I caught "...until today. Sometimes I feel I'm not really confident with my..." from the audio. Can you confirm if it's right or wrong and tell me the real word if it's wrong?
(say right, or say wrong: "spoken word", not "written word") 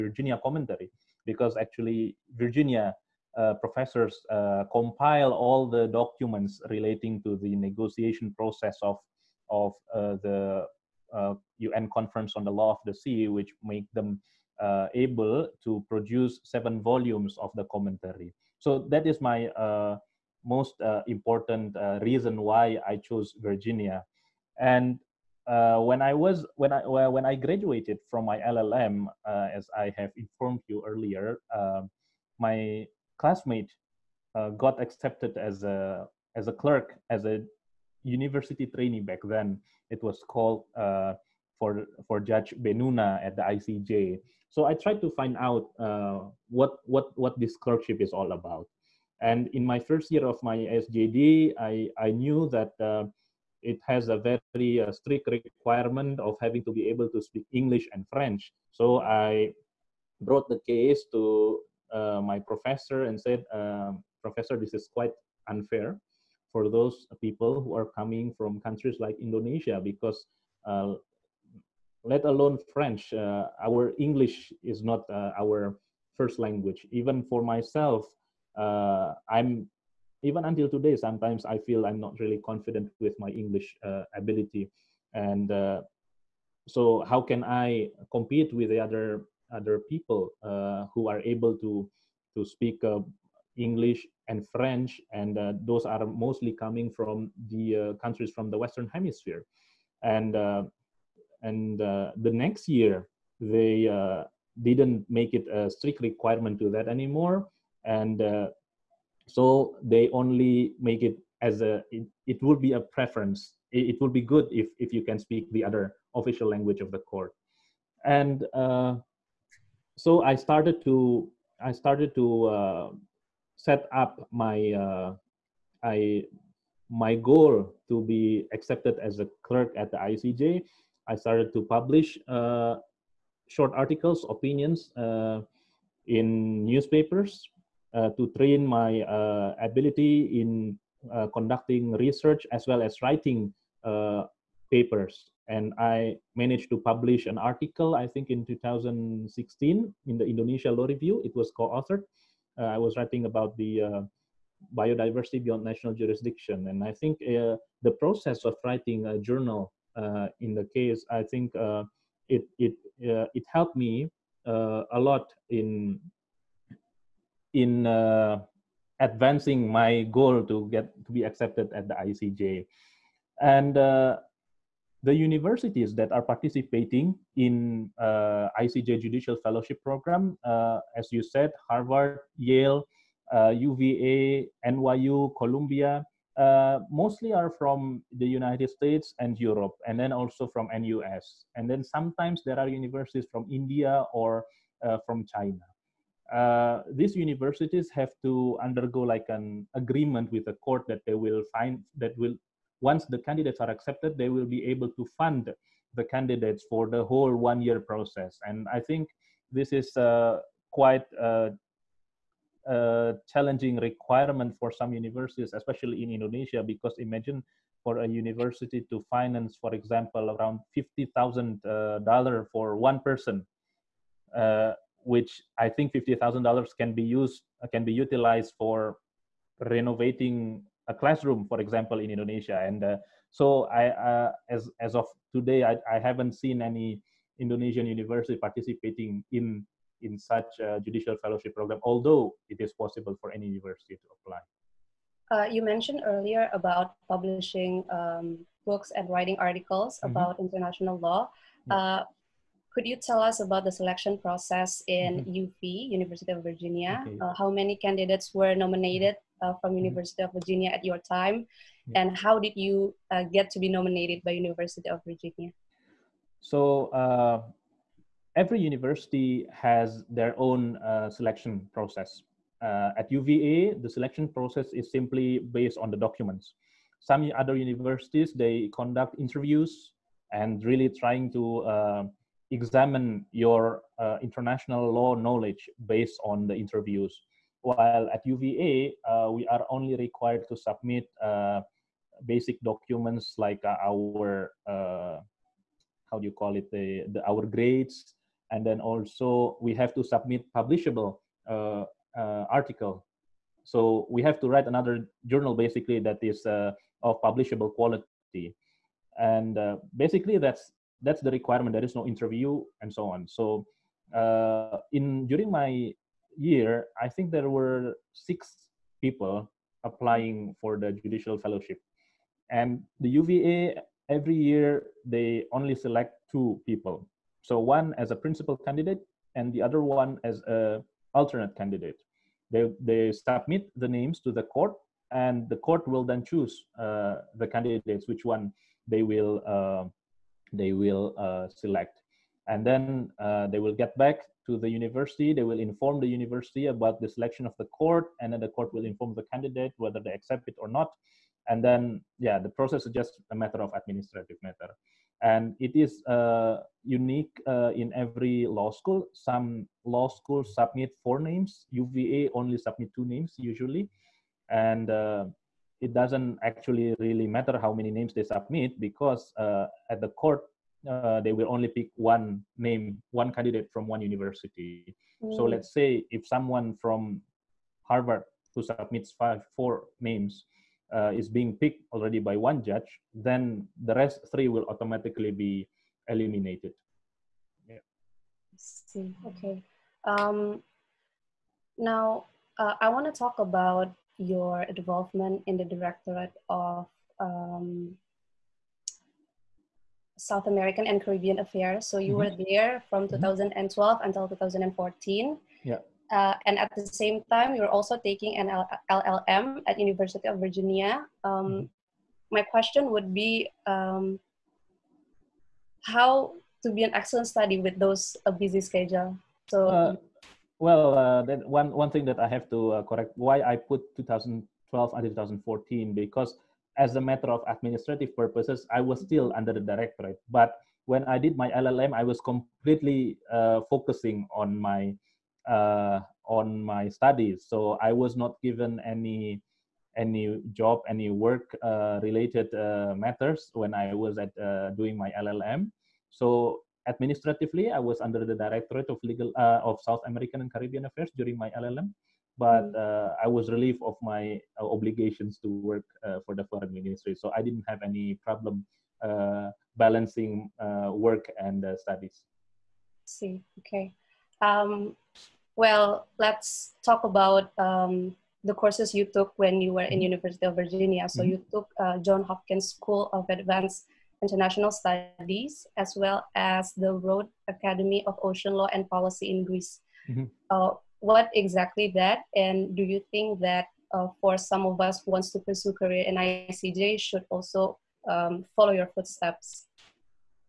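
right.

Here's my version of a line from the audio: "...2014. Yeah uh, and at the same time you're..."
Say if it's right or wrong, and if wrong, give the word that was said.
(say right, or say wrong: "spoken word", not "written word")
right.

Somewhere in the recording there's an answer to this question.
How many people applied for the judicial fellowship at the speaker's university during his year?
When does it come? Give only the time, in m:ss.
5:18.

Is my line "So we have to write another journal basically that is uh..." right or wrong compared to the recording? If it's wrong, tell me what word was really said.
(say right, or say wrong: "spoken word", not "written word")
right.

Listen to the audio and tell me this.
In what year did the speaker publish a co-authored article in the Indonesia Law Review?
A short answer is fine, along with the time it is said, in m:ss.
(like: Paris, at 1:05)
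2016, at 2:28.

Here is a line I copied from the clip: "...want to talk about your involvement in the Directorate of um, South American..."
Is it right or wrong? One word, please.
right.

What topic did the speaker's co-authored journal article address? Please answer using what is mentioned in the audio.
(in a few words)
biodiversity beyond national jurisdiction.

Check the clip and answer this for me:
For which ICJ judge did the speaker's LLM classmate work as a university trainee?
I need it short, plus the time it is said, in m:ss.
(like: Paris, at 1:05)
Judge Bennouna, at 0:42.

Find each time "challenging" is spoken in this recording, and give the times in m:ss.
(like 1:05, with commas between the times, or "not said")
3:33.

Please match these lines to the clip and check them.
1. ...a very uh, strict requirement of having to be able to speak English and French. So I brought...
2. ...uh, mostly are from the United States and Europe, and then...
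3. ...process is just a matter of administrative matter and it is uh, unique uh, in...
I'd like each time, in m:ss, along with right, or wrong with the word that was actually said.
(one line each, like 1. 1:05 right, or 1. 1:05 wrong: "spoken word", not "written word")
1. 0:54 right
2. 3:06 right
3. 5:52 right.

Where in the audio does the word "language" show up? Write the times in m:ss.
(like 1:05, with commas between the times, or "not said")
1:16, 1:56.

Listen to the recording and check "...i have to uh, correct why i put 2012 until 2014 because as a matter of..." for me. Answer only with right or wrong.
right.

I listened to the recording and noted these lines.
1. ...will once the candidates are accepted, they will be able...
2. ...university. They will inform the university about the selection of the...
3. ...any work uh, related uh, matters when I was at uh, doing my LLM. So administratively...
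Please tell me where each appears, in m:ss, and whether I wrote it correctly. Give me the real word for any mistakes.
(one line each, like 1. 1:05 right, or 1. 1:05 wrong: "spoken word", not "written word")
1. 3:22 right
2. 5:44 right
3. 7:20 right.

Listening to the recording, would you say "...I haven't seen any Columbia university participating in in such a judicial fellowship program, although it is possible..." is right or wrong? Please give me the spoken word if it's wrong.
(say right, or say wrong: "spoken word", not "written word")
wrong: "Indonesian", not "Columbia".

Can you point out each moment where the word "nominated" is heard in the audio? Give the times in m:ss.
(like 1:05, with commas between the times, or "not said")
4:18, 4:23.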